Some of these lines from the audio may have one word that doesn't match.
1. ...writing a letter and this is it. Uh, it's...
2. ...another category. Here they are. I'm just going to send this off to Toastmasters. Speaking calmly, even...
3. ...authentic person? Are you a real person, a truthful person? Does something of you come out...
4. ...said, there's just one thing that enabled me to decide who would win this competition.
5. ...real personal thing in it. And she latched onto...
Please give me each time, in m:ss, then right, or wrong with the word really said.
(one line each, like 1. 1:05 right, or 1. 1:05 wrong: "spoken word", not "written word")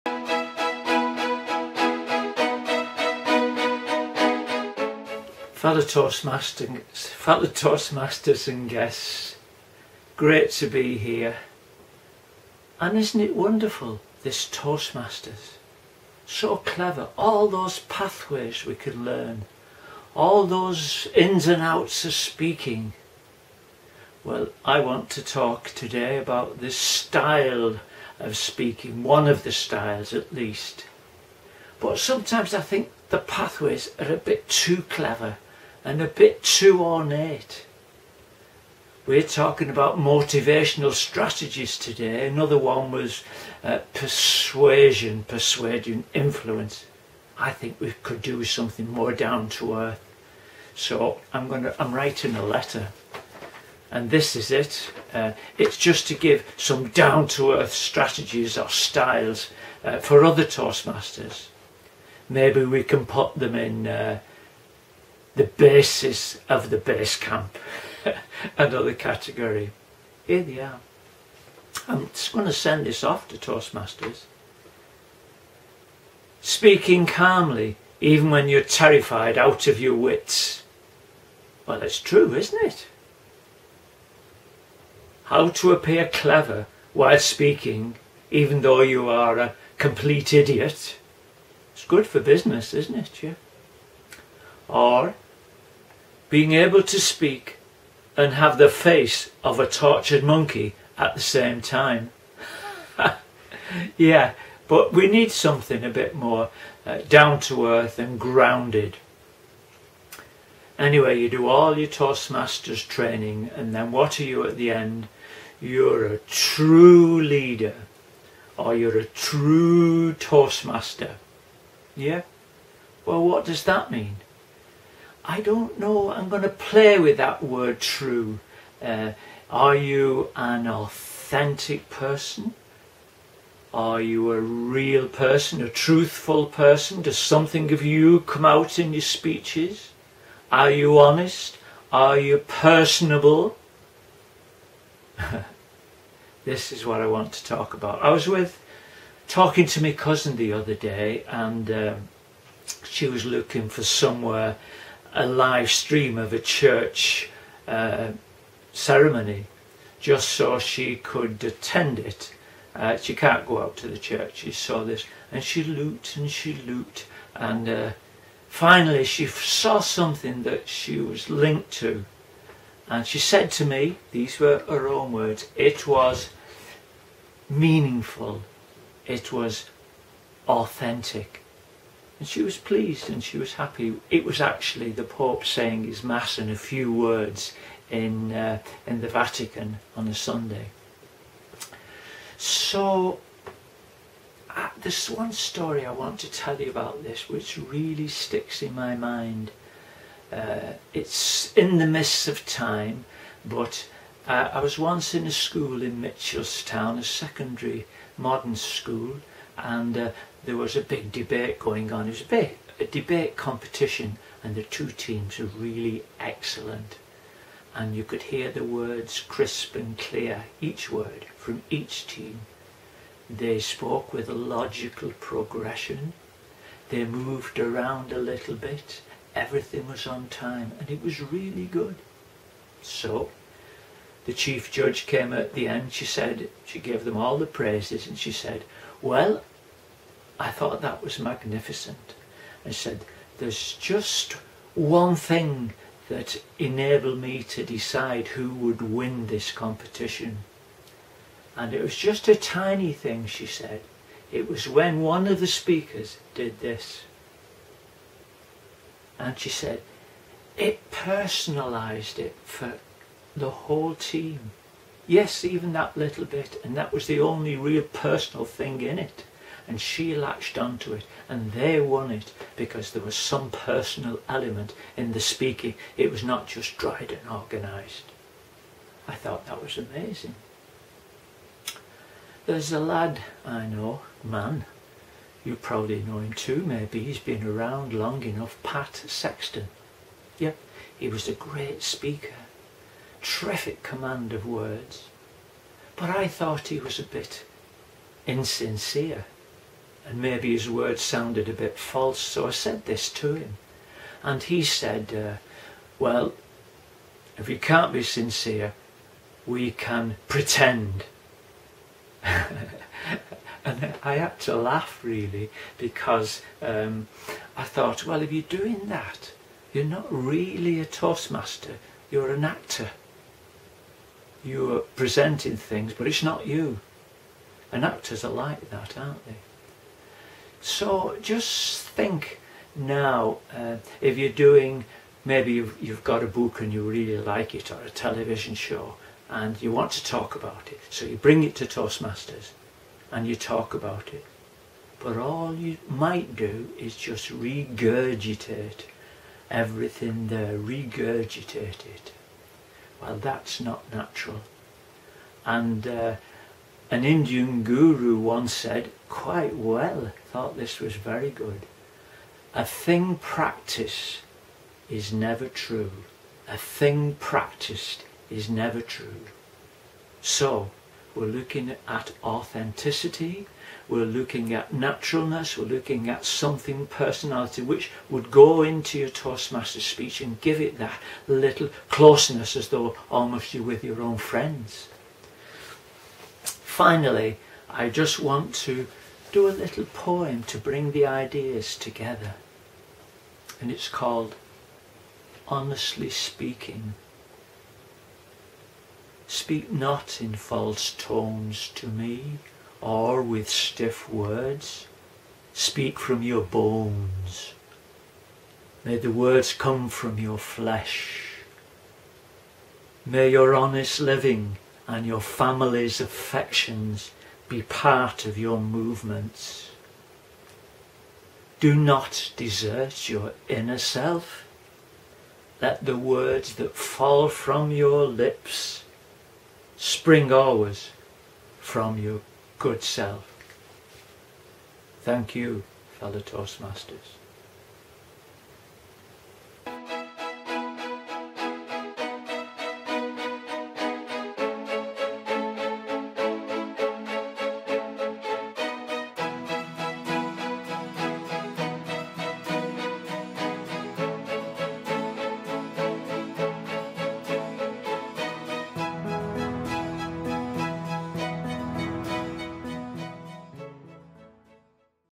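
1. 0:51 right
2. 1:08 right
3. 2:10 right
4. 4:02 right
5. 4:27 right.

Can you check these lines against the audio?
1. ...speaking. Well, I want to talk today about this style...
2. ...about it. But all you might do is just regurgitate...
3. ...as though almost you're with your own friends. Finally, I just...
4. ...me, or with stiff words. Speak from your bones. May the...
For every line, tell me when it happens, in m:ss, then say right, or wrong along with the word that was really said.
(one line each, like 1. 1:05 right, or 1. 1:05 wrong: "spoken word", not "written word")
1. 0:22 right
2. 5:43 right
3. 6:22 right
4. 6:41 right.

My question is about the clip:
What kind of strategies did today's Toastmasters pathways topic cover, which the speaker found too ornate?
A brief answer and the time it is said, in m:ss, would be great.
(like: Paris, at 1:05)
Motivational strategies, at 0:39.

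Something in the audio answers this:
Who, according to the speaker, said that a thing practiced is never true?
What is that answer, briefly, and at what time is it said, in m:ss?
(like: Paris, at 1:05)
An Indian guru, at 5:56.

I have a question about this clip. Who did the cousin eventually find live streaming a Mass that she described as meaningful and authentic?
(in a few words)
The Pope.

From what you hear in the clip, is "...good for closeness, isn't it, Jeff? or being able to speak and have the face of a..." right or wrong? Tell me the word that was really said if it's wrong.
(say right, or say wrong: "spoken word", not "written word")
wrong: "business", not "closeness".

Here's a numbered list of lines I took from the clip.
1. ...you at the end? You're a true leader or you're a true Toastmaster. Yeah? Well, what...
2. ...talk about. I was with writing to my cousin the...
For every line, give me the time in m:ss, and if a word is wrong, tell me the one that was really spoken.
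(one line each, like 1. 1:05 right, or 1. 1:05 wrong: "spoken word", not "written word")
1. 1:54 right
2. 2:27 wrong: "talking", not "writing".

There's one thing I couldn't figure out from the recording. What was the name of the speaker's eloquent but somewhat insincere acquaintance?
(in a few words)
Pat Sexton.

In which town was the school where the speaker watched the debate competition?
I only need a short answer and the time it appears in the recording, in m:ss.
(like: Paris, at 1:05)
Mitchellstown, at 3:26.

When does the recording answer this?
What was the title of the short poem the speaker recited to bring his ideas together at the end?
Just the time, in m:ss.
6:35.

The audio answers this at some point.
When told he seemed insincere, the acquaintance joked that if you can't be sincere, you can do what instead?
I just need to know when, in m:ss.
5:10.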